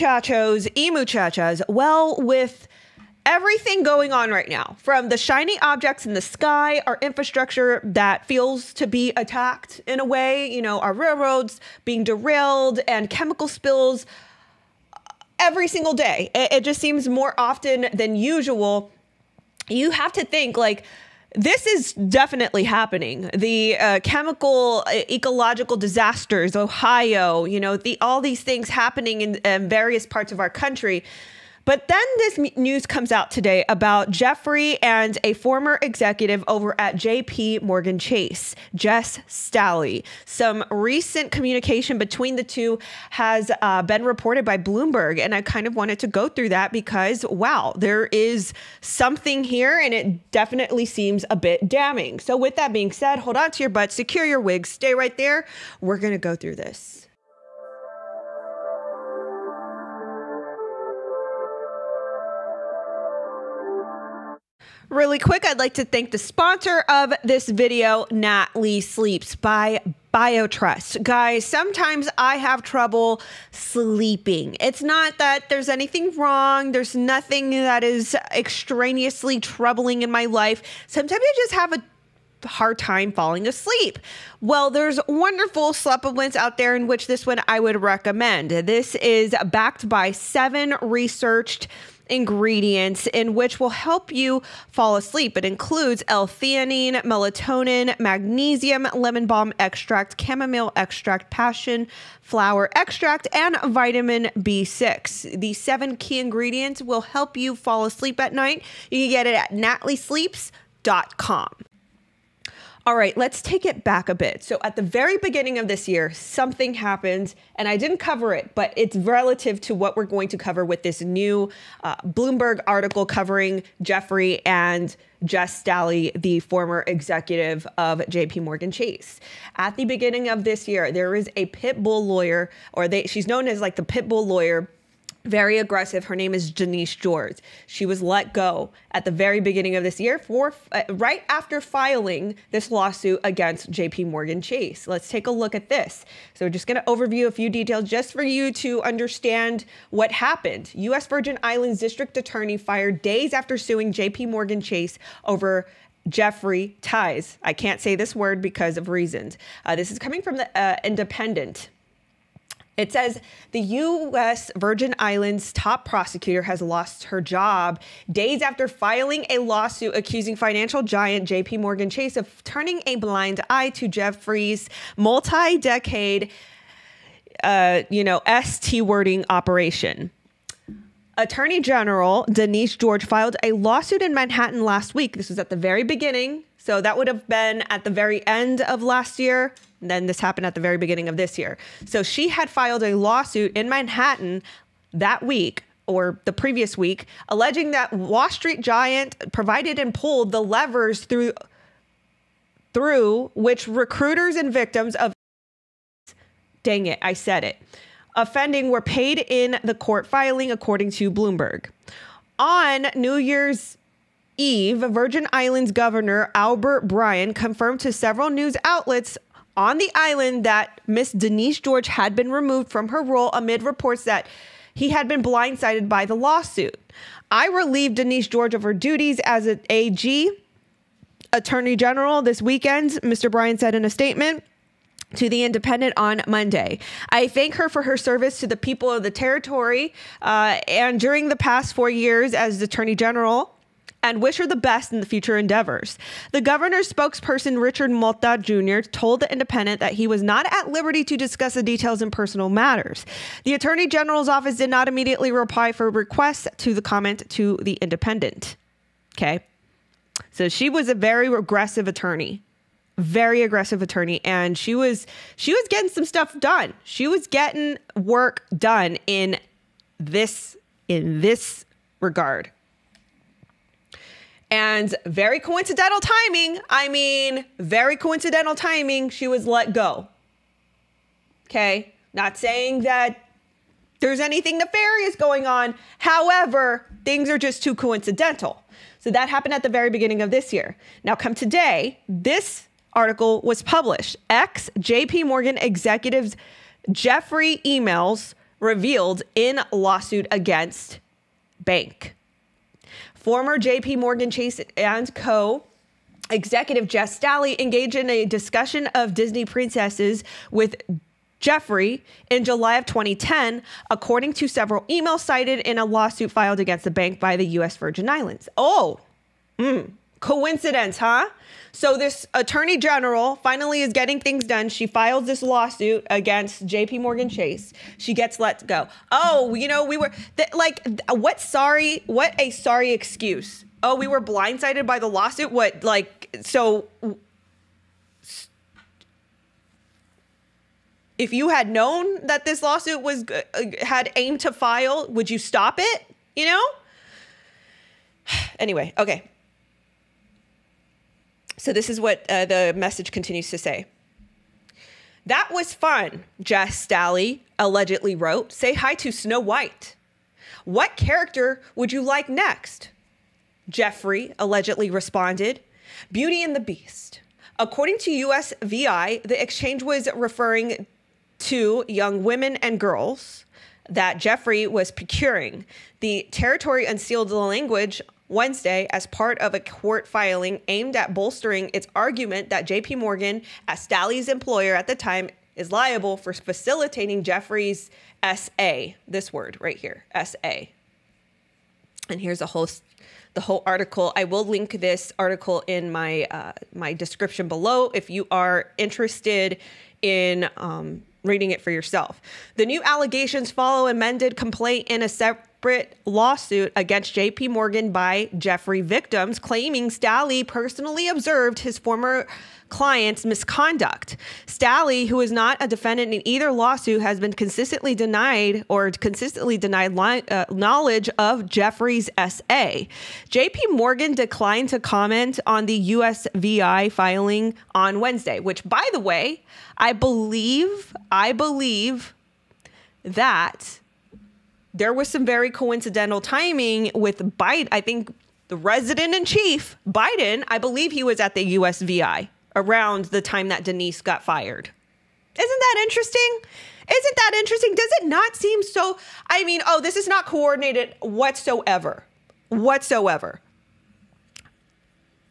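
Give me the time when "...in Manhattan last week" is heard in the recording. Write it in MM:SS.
03:04.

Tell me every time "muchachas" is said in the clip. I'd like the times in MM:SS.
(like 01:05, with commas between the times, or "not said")
00:00.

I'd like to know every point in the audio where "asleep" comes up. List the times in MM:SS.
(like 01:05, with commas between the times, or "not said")
01:23, 01:34, 01:47.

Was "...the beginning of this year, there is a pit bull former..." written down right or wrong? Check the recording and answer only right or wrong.
wrong.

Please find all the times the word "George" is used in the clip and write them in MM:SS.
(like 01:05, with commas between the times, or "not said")
02:16, 03:02, 03:41, 03:48.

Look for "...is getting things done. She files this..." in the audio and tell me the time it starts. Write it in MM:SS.
05:23.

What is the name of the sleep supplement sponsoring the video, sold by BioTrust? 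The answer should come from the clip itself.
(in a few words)
Natly Sleeps.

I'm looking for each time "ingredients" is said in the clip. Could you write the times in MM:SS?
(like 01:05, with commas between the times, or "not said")
01:32, 01:46.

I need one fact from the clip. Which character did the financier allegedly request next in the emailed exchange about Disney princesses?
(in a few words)
Beauty and the Beast.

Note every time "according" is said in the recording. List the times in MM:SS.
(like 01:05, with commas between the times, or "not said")
03:30, 05:13, 06:07.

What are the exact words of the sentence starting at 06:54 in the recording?
Staley, who is not a defendant in either lawsuit, has been consistently denied or consistently denied li- uh, knowledge of Jeffrey's SA.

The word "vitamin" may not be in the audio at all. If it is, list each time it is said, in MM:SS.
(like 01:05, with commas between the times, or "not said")
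01:43.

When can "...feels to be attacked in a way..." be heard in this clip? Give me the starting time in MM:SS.
00:08.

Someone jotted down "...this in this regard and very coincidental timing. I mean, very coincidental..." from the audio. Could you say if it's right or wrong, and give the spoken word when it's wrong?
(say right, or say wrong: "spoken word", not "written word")
right.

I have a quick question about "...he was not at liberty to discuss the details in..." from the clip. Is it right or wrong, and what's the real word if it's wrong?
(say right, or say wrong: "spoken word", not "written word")
right.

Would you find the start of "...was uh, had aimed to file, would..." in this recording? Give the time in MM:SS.
05:43.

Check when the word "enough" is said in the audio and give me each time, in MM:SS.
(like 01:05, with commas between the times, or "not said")
not said.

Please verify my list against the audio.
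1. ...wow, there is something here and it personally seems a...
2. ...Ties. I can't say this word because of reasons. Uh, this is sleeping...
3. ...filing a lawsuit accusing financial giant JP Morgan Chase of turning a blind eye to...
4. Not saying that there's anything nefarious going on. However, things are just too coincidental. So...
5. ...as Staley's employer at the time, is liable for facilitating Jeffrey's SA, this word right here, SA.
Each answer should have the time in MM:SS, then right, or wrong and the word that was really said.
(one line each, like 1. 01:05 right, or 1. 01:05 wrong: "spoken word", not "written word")
1. 00:47 wrong: "definitely", not "personally"
2. 02:36 wrong: "coming", not "sleeping"
3. 02:48 right
4. 04:42 right
5. 06:23 right.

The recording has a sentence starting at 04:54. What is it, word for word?
Ex JP Morgan executives Jeffrey emails revealed in lawsuit against bank.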